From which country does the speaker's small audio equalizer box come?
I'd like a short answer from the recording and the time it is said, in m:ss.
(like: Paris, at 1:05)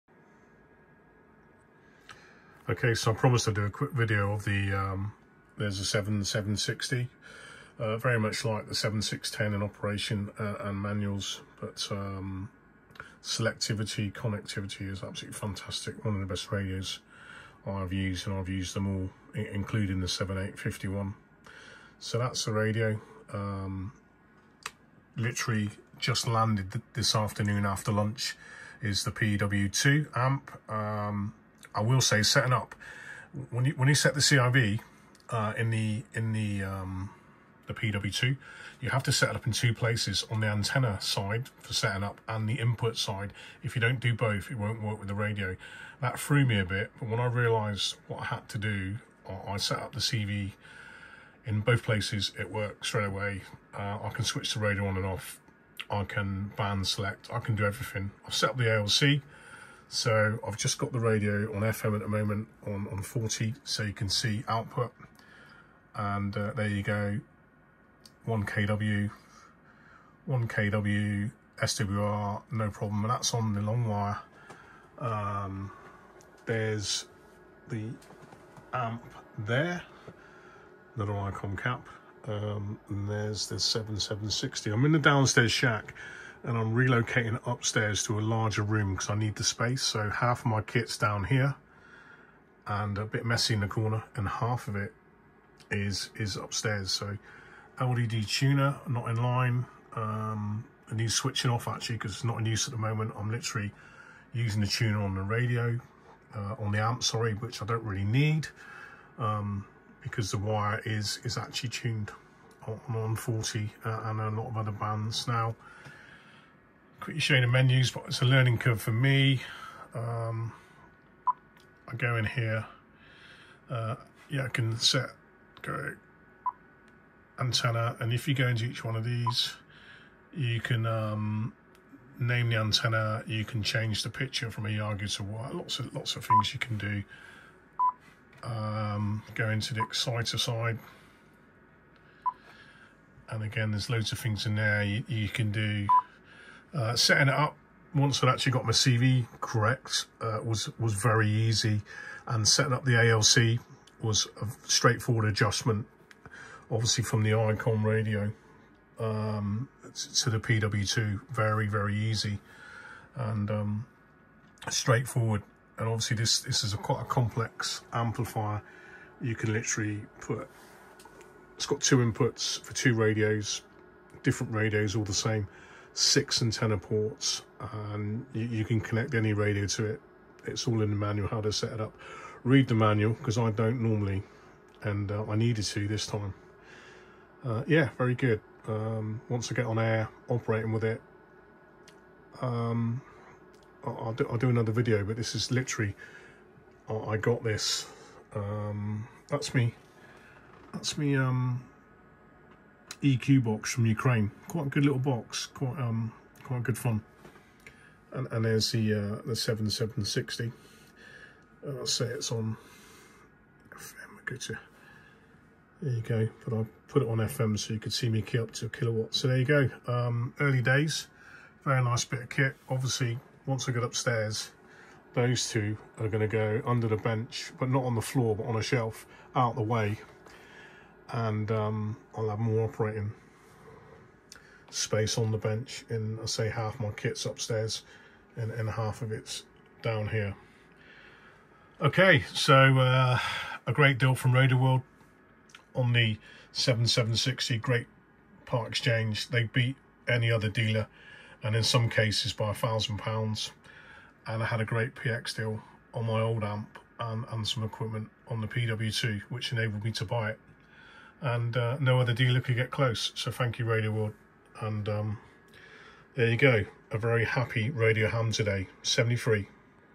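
Ukraine, at 3:23.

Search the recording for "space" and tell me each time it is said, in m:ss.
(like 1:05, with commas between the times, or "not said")
1:29, 3:54.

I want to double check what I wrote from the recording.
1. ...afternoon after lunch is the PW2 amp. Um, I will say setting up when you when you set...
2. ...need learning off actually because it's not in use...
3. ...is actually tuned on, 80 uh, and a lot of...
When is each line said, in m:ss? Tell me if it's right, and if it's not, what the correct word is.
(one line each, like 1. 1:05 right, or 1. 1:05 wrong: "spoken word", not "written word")
1. 0:27 right
2. 1:40 wrong: "switching", not "learning"
3. 1:51 wrong: "40", not "80".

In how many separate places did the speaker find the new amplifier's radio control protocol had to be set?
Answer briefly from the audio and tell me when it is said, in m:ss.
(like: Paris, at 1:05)
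2, at 0:39.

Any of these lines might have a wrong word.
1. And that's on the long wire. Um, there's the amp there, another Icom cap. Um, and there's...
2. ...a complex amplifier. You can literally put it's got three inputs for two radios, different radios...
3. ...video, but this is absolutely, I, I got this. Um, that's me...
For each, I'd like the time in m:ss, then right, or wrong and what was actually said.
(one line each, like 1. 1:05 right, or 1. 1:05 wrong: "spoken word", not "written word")
1. 1:13 right
2. 2:47 wrong: "two", not "three"
3. 3:14 wrong: "literally", not "absolutely".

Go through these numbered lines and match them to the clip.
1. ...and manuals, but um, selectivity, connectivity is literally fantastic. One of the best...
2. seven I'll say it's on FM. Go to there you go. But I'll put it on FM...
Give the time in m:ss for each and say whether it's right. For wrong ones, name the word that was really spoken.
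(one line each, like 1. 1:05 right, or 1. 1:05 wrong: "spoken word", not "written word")
1. 0:10 wrong: "absolutely", not "literally"
2. 3:30 right.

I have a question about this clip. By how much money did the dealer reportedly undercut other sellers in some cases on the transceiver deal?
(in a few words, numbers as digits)
£1,000.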